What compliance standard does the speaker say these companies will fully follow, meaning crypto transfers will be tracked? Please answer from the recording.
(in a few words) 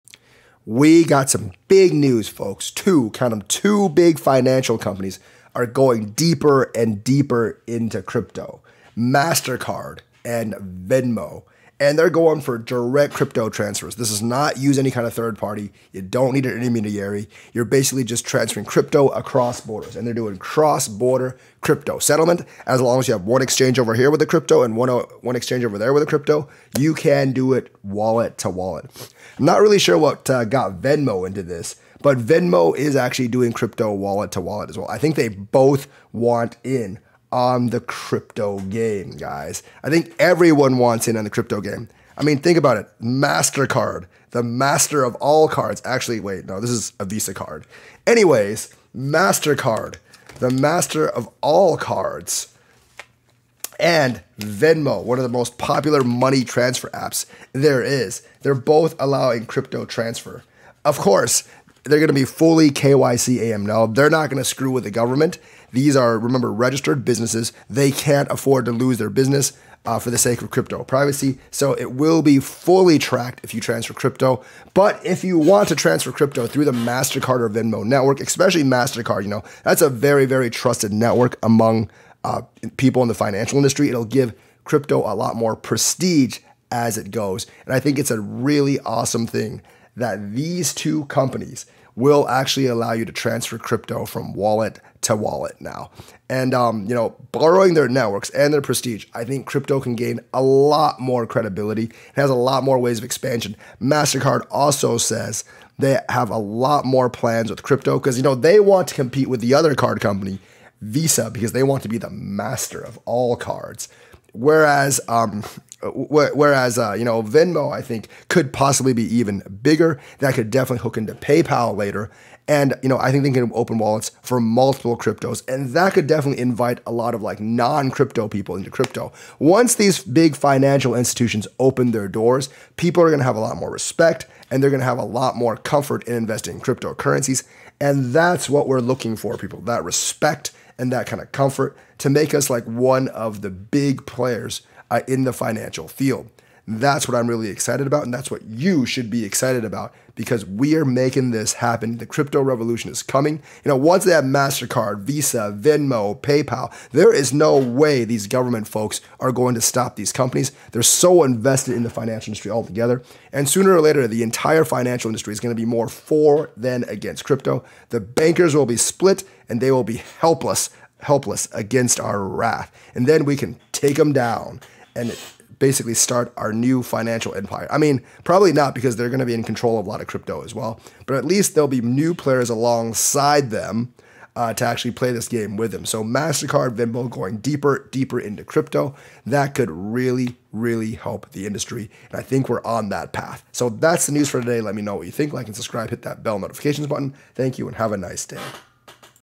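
KYC AML.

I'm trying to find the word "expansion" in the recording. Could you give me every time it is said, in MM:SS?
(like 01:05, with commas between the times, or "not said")
01:43.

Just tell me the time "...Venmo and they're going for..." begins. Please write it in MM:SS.
00:10.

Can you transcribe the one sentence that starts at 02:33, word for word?
You know, once they have MasterCard, Visa, Venmo, PayPal, there is no way these government folks are going to stop these companies.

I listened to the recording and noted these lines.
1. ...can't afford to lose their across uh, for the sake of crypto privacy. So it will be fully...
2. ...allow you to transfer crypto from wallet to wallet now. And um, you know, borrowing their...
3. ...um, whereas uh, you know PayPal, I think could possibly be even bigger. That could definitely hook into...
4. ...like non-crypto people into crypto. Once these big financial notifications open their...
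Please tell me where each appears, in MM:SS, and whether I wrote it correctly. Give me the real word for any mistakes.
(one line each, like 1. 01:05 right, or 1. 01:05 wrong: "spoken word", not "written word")
1. 01:07 wrong: "business", not "across"
2. 01:32 right
3. 01:55 wrong: "Venmo", not "PayPal"
4. 02:07 wrong: "institutions", not "notifications".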